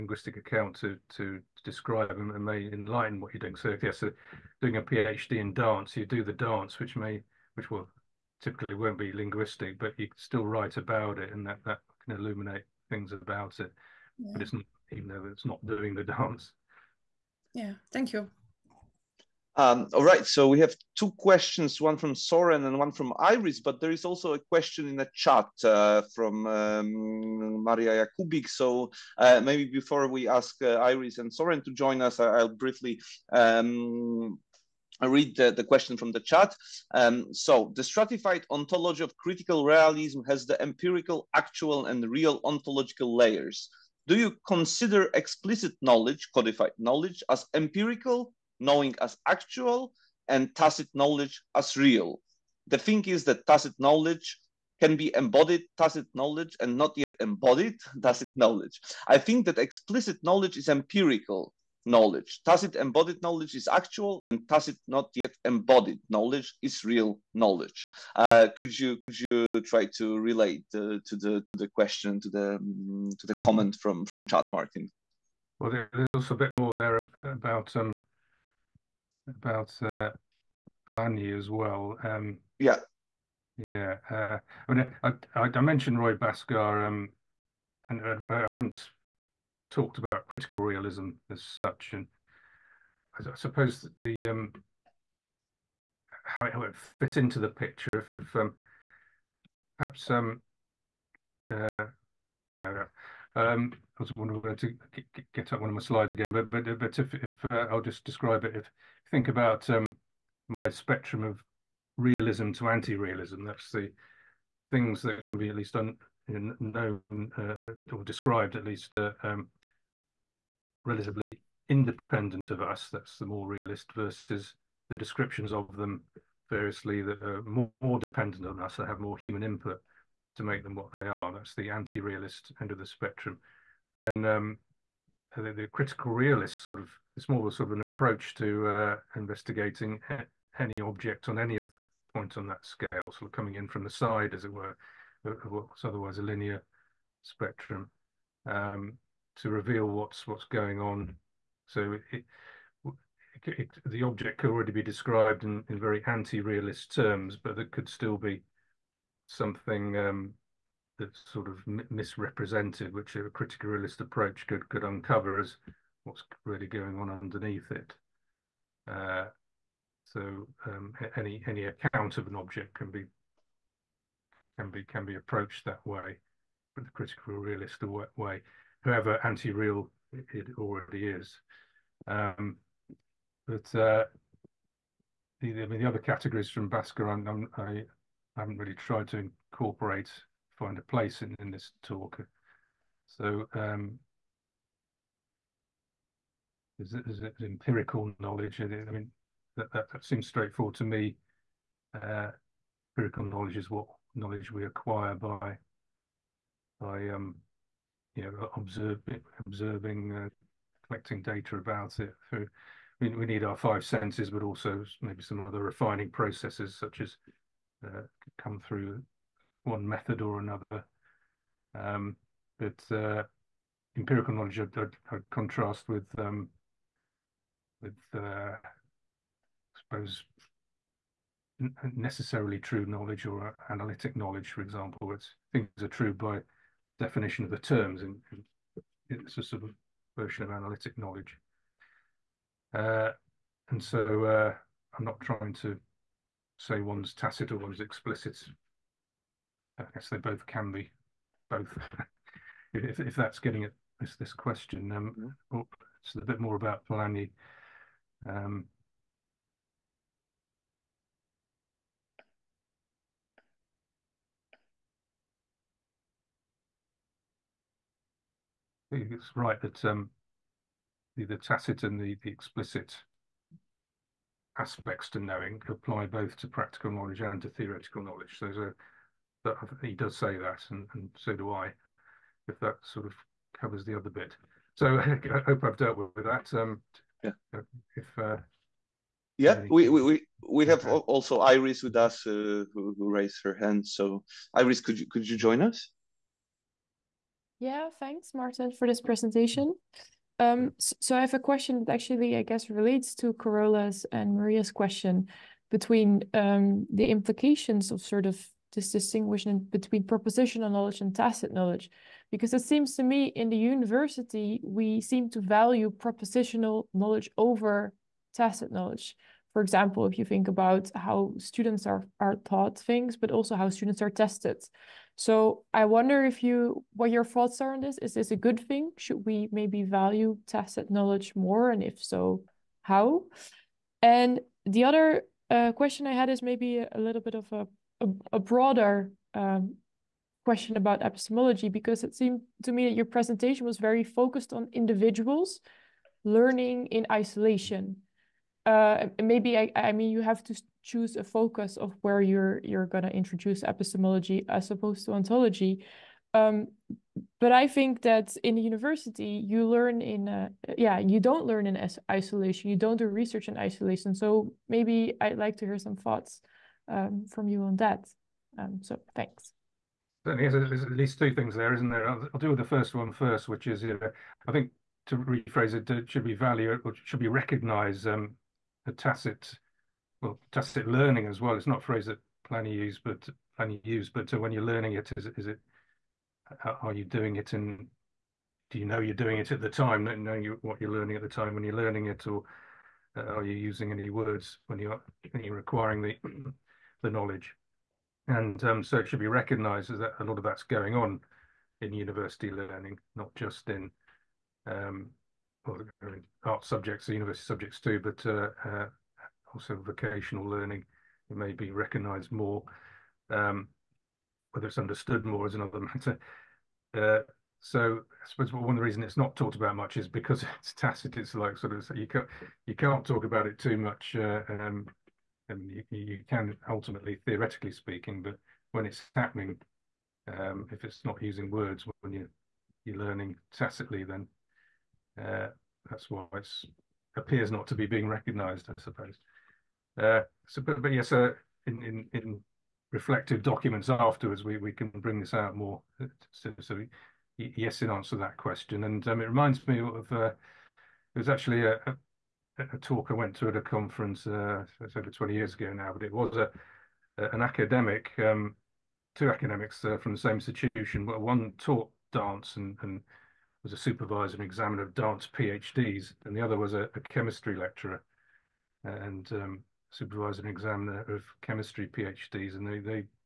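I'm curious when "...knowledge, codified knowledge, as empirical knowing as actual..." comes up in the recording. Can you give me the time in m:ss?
0:45.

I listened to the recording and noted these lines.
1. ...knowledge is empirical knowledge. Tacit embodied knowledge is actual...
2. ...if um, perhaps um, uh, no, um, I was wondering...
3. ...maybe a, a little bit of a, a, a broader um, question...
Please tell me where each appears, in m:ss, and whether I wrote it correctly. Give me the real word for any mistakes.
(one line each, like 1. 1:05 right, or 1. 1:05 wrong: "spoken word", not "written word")
1. 1:00 right
2. 1:38 right
3. 5:36 right.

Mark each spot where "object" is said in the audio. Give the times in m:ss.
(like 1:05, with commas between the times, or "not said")
2:20, 2:34, 2:52.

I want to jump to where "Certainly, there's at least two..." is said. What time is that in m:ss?
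6:10.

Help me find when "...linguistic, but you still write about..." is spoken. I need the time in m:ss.
0:09.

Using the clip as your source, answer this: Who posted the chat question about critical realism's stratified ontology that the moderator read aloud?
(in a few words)
Maria Jakubik.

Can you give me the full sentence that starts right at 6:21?
It's not a phrase that plenty used, but Pliny use.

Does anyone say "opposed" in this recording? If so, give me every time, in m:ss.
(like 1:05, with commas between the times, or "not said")
5:54.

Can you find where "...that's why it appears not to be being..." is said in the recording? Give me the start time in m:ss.
7:15.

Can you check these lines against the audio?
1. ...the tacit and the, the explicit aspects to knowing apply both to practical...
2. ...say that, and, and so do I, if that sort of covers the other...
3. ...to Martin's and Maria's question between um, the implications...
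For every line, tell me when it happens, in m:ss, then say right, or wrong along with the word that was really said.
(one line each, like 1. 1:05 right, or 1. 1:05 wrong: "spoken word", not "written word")
1. 4:31 right
2. 4:40 right
3. 5:03 wrong: "Carola", not "Martin".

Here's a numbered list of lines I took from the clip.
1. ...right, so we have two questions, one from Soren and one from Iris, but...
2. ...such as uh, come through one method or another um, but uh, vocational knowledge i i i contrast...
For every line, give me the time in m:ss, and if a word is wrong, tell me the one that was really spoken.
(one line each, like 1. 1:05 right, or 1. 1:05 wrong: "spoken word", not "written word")
1. 0:20 right
2. 3:36 wrong: "empirical", not "vocational".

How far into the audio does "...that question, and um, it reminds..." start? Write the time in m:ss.
7:28.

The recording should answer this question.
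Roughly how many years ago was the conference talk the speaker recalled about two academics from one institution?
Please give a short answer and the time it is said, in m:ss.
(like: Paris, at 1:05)
over 20, at 7:34.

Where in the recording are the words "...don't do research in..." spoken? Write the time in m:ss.
6:02.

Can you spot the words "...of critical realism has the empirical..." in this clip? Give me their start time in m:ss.
0:39.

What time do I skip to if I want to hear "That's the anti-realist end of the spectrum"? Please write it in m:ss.
2:11.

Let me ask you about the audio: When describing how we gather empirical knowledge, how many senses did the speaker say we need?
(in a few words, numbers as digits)
5.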